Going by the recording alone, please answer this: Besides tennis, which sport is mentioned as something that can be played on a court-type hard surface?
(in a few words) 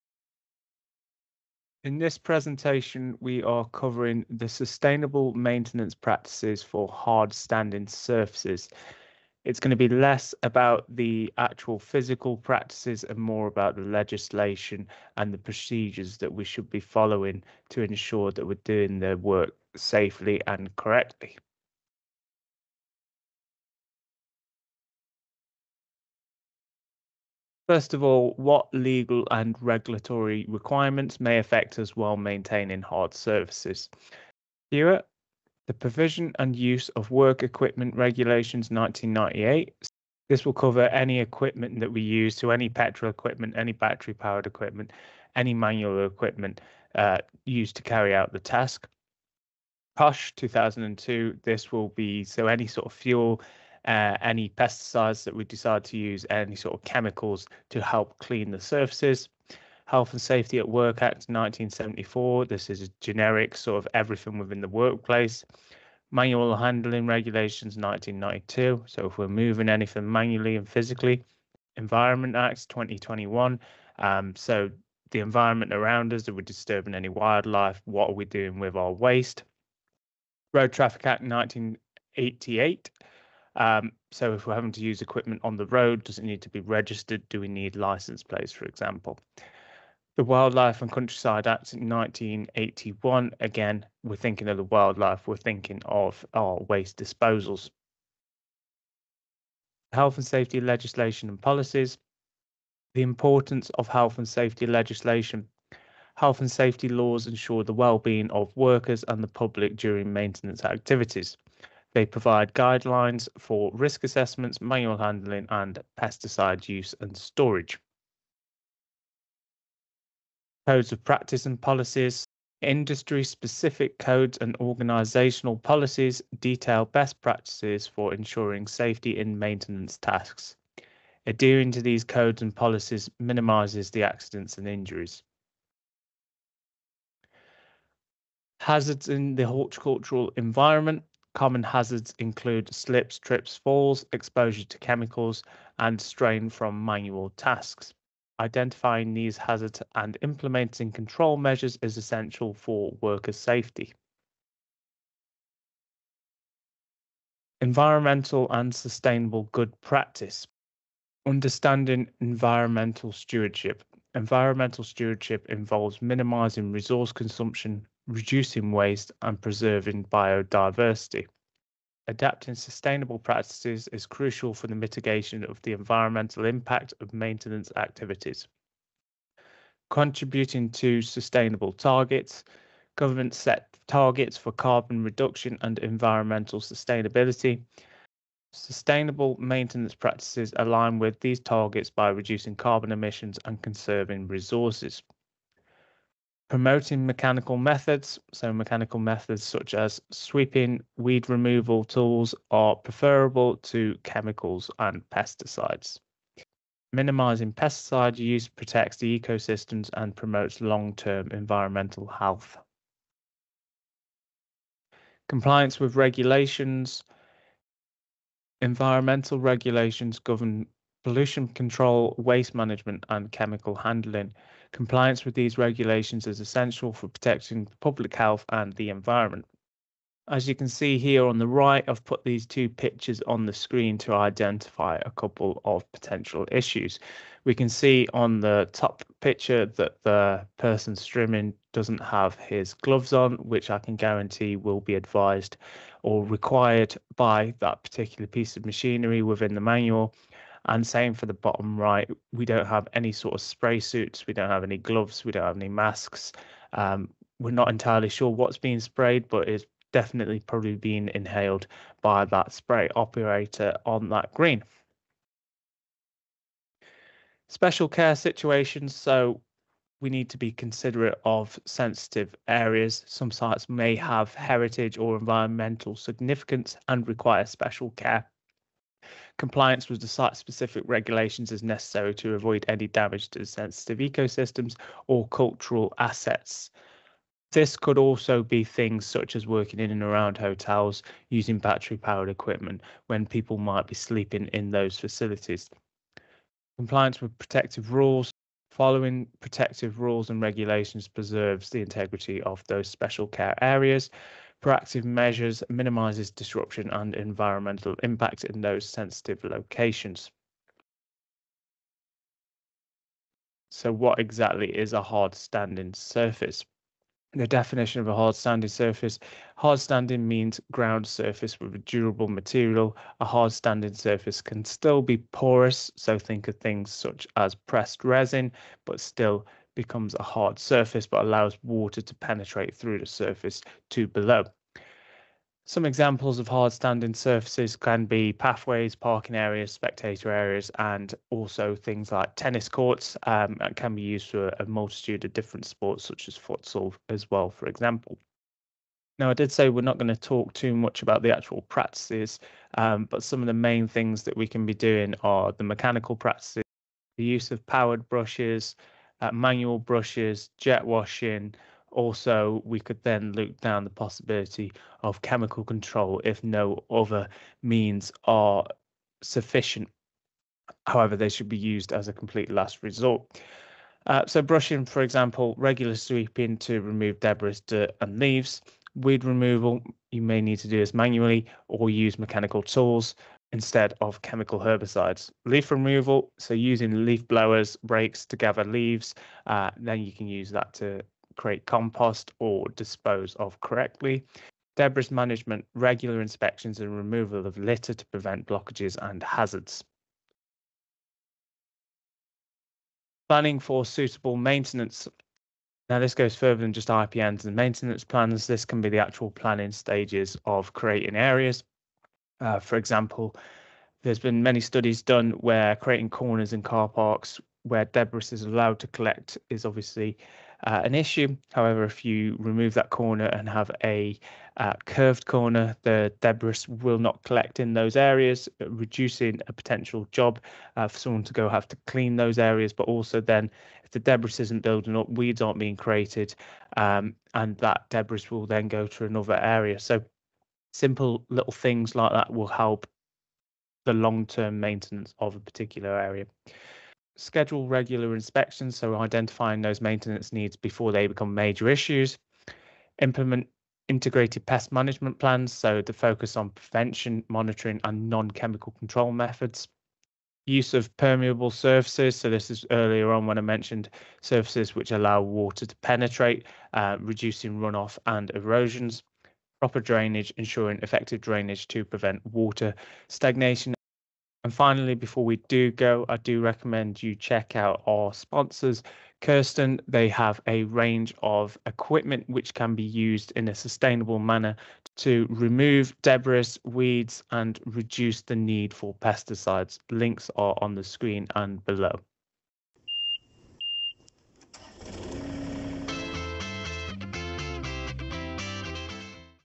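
futsal.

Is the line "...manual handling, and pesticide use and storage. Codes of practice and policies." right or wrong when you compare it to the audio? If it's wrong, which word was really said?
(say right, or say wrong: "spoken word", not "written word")
right.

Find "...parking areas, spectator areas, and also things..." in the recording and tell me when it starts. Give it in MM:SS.
05:38.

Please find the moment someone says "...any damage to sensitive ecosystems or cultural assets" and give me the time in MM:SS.
04:42.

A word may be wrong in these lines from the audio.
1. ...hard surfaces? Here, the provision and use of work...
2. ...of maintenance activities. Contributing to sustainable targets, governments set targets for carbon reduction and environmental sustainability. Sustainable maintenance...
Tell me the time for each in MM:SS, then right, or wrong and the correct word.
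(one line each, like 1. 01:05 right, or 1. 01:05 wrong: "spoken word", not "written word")
1. 00:32 right
2. 02:56 right.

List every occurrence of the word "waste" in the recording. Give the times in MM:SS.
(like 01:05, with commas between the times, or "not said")
01:18, 01:36, 02:48, 03:42.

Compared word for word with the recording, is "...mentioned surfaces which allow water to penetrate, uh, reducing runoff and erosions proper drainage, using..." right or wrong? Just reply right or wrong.
wrong.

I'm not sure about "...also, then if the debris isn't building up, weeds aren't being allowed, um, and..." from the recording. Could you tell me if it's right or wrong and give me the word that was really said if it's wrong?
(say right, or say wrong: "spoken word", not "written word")
wrong: "created", not "allowed".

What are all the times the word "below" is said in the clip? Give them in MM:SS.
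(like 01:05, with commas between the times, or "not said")
05:34, 08:11.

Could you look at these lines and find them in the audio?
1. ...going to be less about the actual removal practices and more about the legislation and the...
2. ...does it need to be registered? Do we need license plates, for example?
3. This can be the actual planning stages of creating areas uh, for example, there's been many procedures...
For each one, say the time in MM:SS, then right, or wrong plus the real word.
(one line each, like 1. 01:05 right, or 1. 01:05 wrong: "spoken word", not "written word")
1. 00:09 wrong: "physical", not "removal"
2. 01:26 right
3. 06:48 wrong: "studies", not "procedures".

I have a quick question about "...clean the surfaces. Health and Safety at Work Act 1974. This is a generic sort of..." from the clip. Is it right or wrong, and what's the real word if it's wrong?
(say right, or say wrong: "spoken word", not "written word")
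right.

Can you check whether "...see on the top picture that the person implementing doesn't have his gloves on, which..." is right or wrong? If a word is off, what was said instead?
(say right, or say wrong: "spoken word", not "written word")
wrong: "strimming", not "implementing".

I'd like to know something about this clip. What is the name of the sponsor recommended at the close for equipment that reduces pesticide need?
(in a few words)
Kersten.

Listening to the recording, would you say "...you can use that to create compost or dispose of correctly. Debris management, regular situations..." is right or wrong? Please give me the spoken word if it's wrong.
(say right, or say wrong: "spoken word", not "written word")
wrong: "inspections", not "situations".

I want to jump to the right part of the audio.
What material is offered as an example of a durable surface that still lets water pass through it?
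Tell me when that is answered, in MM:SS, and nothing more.
05:27.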